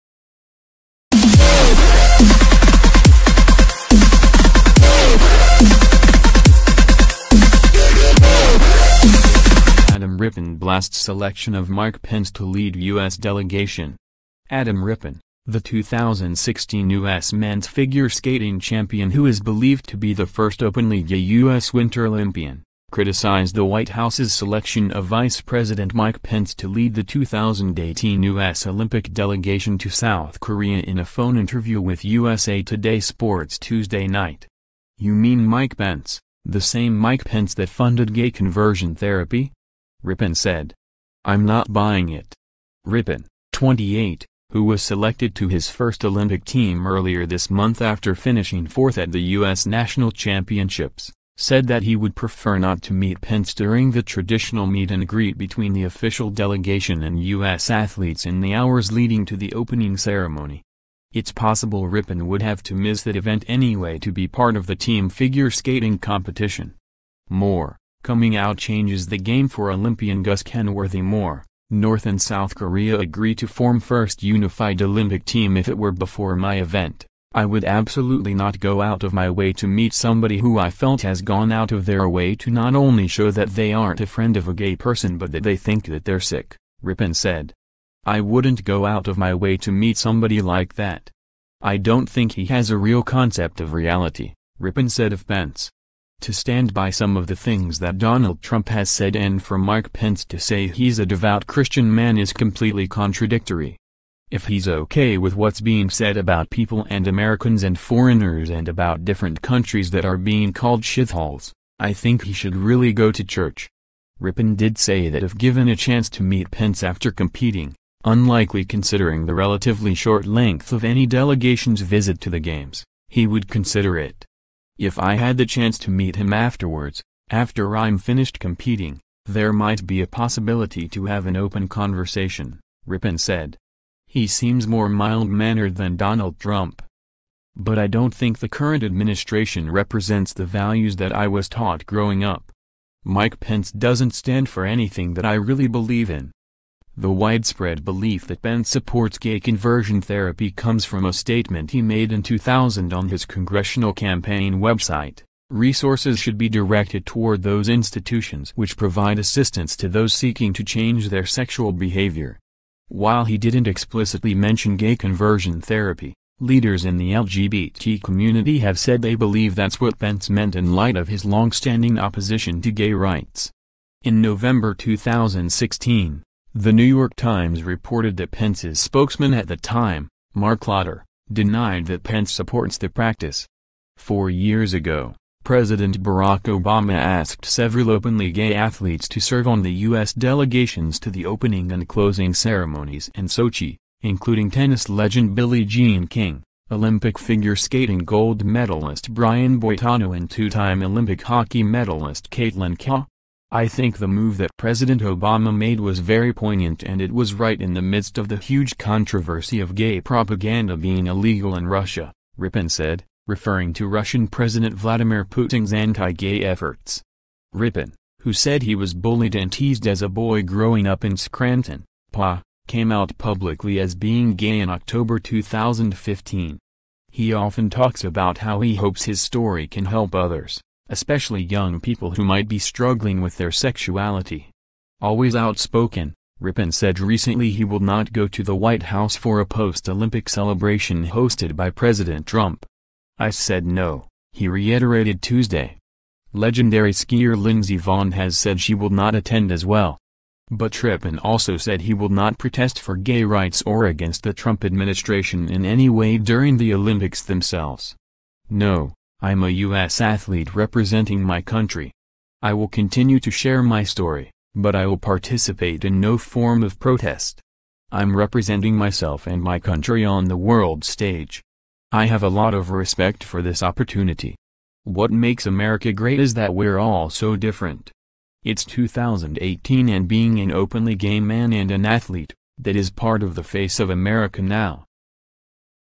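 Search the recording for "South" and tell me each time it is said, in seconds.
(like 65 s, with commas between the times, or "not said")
29 s, 72 s.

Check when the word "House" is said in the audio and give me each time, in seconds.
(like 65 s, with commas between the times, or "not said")
23 s, 238 s.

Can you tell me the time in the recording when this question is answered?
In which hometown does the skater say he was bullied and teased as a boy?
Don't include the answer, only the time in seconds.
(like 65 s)
221 s.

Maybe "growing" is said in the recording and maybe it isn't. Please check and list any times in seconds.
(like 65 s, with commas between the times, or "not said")
141 s, 220 s.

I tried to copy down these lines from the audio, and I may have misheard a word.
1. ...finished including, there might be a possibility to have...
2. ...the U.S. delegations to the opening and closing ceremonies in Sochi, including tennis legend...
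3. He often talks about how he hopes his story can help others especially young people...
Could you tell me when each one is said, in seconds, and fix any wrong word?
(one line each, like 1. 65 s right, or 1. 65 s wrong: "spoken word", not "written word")
1. 127 s wrong: "competing", not "including"
2. 189 s right
3. 227 s right.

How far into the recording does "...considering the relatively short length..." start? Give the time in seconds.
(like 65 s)
118 s.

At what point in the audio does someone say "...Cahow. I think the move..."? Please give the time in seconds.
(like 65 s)
202 s.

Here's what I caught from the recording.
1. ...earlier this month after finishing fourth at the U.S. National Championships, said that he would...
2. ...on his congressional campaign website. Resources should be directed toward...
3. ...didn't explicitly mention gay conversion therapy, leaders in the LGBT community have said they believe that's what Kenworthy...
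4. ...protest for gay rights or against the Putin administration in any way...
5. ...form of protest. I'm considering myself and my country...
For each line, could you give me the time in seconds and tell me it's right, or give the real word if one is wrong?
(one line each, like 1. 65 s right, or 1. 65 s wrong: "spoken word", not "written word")
1. 46 s right
2. 152 s right
3. 163 s wrong: "Pence", not "Kenworthy"
4. 252 s wrong: "Trump", not "Putin"
5. 266 s wrong: "representing", not "considering".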